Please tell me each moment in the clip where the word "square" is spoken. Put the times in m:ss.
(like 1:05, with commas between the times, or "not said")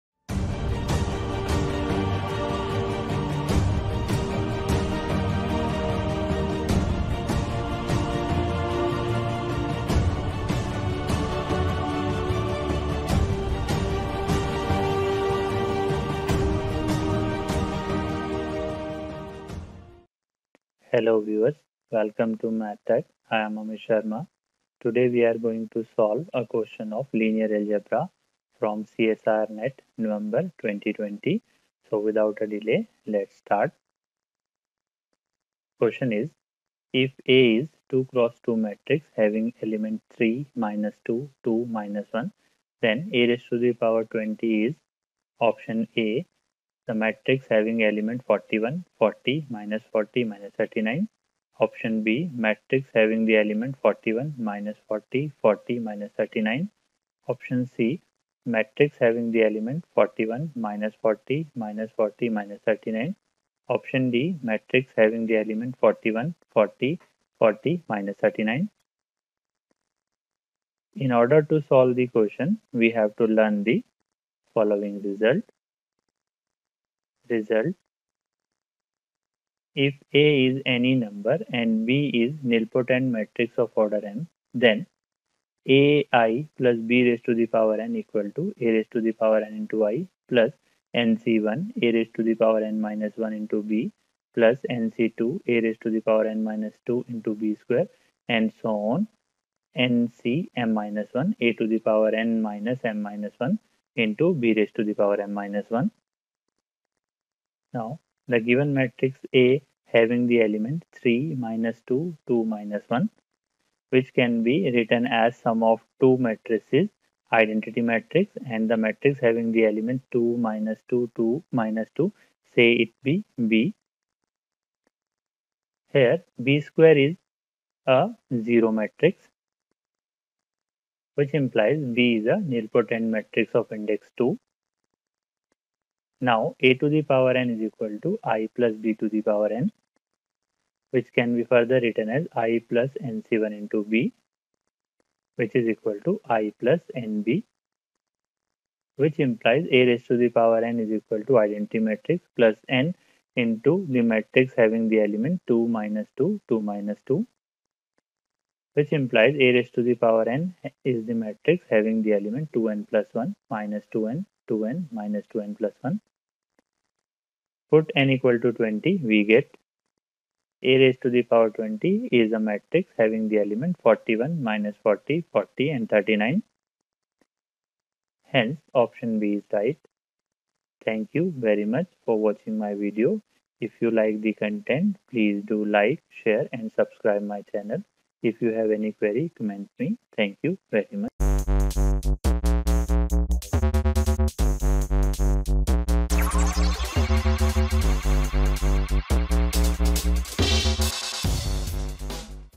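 1:37, 2:06.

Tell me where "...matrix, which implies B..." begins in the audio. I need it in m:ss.
2:08.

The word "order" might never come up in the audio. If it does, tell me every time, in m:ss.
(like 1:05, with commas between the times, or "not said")
1:11, 1:23.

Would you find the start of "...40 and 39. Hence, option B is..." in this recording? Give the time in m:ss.
2:55.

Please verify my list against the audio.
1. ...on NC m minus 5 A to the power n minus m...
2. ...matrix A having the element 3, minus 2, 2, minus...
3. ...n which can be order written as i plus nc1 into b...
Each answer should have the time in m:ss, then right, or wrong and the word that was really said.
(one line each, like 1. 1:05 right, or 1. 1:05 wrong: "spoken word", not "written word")
1. 1:38 wrong: "1", not "5"
2. 1:48 right
3. 2:19 wrong: "further", not "order".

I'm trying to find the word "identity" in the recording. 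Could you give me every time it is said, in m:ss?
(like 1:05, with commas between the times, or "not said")
1:57, 2:31.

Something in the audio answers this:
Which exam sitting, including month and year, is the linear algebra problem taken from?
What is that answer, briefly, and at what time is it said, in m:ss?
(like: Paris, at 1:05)
NET November 2020, at 0:29.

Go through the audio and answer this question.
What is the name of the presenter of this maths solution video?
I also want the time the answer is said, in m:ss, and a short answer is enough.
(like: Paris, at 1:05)
Amish Sharma, at 0:23.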